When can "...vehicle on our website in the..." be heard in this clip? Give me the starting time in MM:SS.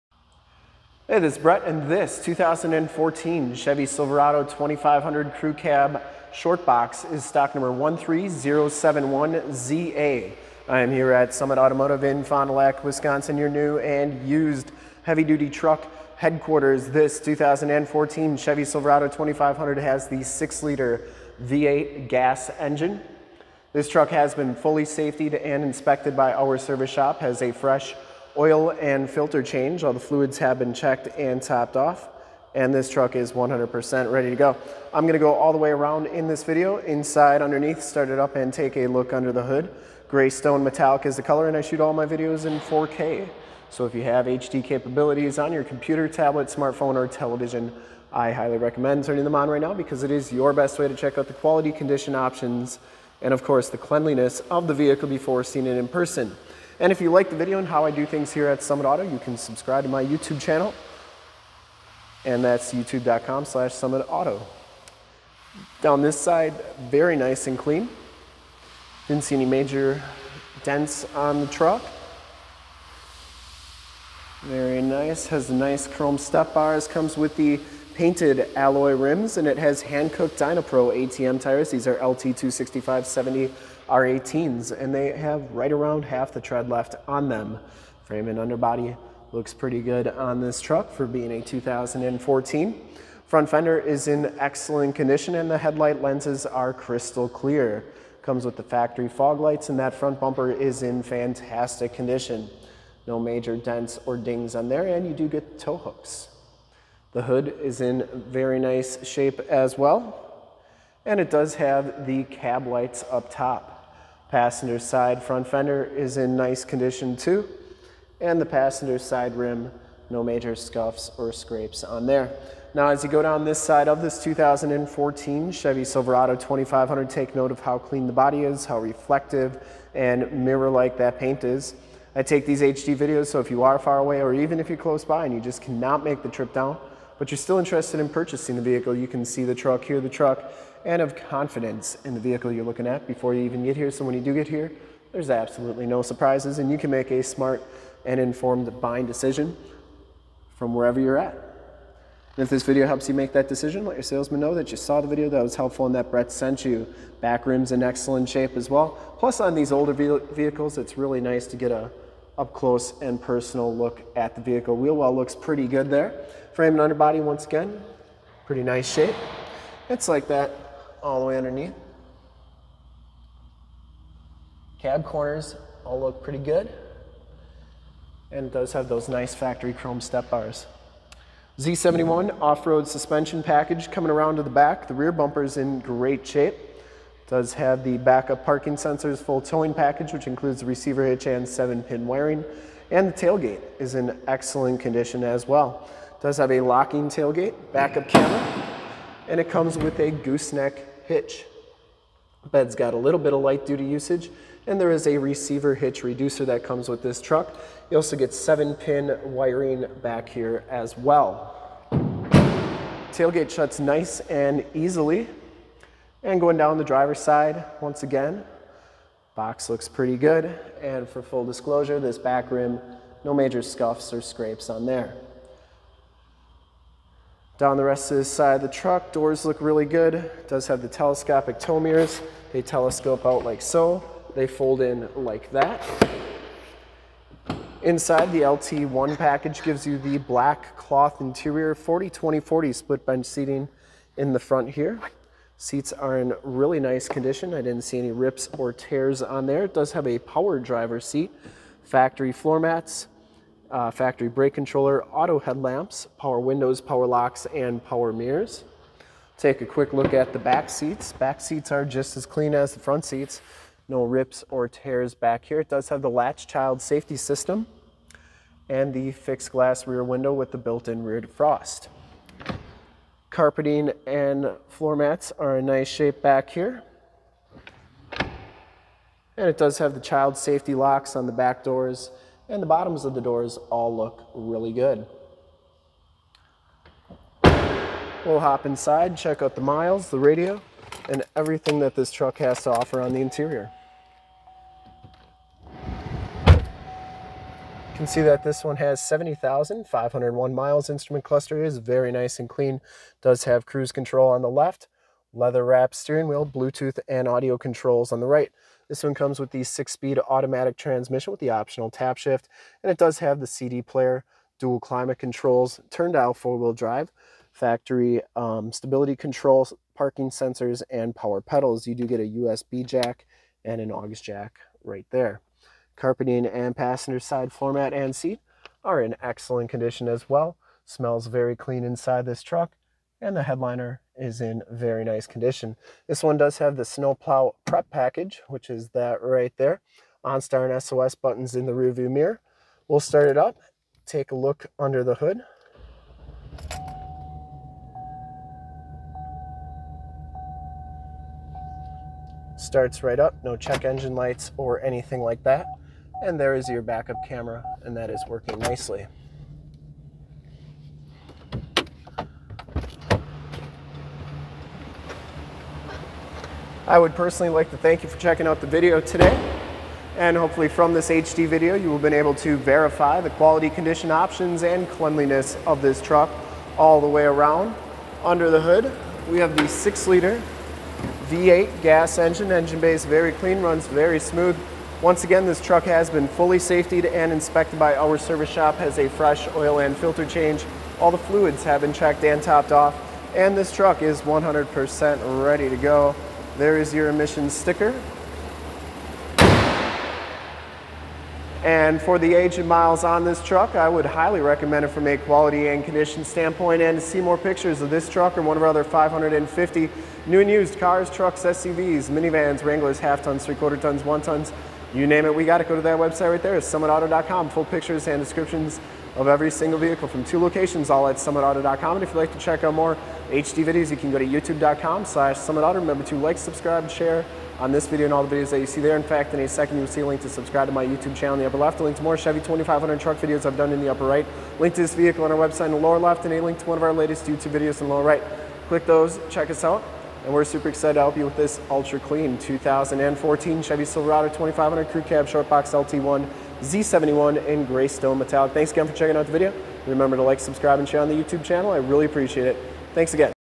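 07:14.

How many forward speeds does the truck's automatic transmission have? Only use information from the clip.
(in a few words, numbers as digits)
six.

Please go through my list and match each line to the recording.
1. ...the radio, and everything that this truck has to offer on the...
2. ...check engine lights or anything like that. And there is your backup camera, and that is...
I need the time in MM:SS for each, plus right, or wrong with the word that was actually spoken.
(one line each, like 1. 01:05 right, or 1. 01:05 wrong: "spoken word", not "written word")
1. 04:50 right
2. 05:53 right.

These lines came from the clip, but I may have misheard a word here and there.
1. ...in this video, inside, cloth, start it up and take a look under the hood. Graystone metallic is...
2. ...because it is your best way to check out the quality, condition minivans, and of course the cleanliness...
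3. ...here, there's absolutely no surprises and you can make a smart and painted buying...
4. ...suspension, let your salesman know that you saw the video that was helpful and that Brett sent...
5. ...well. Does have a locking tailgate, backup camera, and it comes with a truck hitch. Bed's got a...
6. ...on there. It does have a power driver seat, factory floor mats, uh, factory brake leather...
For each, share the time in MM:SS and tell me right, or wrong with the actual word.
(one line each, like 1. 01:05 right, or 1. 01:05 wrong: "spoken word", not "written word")
1. 00:36 wrong: "underneath", not "cloth"
2. 00:49 wrong: "options", not "minivans"
3. 02:24 wrong: "informed", not "painted"
4. 02:33 wrong: "decision", not "suspension"
5. 03:15 wrong: "gooseneck", not "truck"
6. 04:09 wrong: "controller", not "leather".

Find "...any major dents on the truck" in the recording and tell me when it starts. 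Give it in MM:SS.
01:09.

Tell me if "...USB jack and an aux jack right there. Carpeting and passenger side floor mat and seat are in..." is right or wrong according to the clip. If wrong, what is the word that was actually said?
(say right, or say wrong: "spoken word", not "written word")
right.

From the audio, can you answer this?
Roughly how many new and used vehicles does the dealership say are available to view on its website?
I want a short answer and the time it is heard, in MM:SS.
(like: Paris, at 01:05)
550, at 06:48.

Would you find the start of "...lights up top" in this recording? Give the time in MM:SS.
01:52.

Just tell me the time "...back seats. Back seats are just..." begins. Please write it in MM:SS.
04:20.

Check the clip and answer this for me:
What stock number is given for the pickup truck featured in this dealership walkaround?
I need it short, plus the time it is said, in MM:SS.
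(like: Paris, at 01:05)
13071ZA, at 00:07.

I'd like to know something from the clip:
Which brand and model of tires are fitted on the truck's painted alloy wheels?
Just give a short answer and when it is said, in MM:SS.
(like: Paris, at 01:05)
Hankook Dynapro ATM, at 01:19.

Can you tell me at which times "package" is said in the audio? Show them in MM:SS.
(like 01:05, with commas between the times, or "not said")
03:03, 03:09, 03:59, 05:37.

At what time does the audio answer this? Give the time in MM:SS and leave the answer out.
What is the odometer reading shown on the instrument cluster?
04:58.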